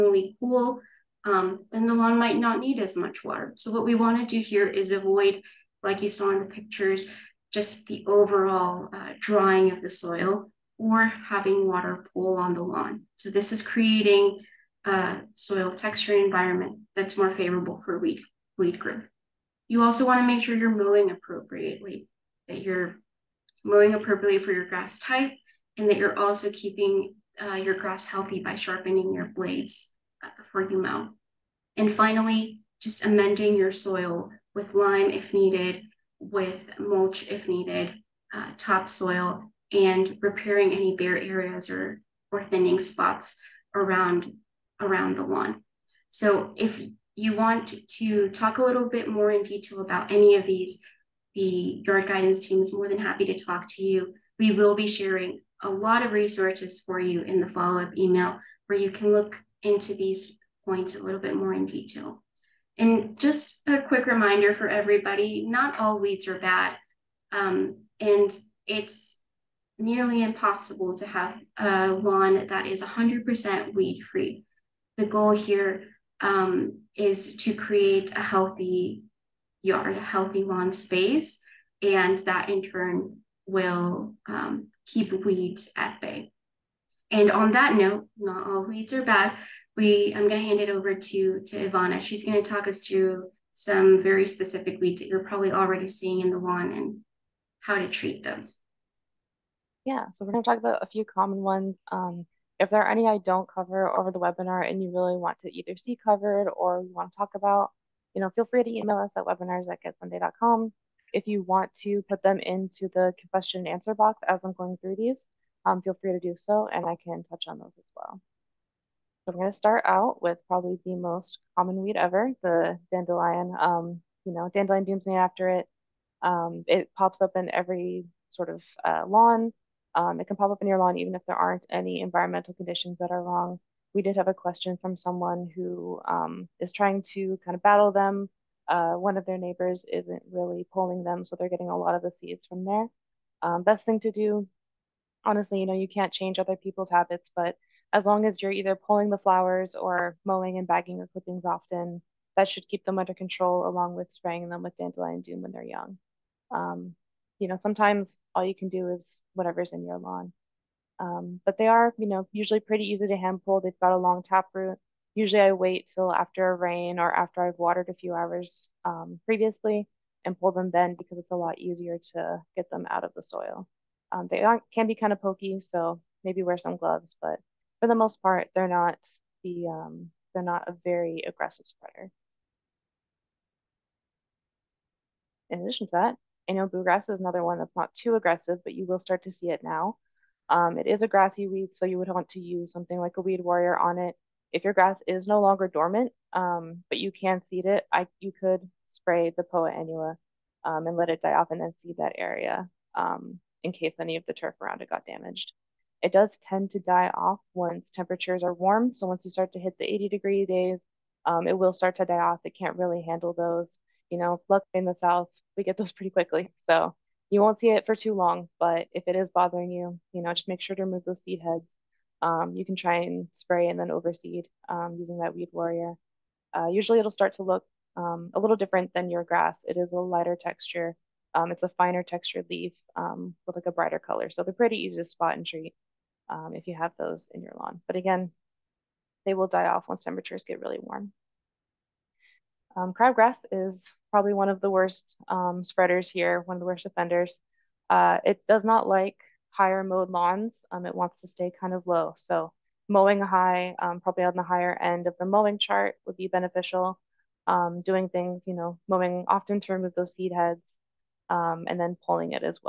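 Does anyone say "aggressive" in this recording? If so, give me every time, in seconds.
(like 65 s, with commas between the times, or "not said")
181 s, 188 s.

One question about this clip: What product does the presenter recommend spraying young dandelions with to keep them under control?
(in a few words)
Dandelion Doom.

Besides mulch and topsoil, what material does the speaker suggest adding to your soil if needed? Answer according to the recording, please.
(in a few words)
Lime.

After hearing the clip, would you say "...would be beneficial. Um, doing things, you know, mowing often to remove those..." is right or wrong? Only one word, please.
right.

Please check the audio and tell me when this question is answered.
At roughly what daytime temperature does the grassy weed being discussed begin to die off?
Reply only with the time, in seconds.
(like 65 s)
209 s.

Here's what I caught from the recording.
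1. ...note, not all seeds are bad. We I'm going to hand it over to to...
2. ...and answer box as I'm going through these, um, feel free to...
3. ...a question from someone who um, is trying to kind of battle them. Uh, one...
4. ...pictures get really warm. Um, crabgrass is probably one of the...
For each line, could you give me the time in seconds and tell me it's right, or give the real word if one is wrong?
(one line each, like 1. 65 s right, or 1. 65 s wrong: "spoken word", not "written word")
1. 87 s wrong: "weeds", not "seeds"
2. 113 s right
3. 134 s right
4. 240 s wrong: "temperatures", not "pictures".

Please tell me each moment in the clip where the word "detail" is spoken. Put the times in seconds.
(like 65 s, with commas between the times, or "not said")
49 s, 61 s.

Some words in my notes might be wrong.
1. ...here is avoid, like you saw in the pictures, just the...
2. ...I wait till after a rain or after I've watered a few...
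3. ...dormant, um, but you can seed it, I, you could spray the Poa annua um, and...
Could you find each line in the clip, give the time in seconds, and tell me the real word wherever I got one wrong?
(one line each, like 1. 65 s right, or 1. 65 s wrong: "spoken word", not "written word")
1. 4 s right
2. 165 s right
3. 195 s right.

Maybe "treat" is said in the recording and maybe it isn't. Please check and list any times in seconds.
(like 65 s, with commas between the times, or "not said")
97 s, 235 s.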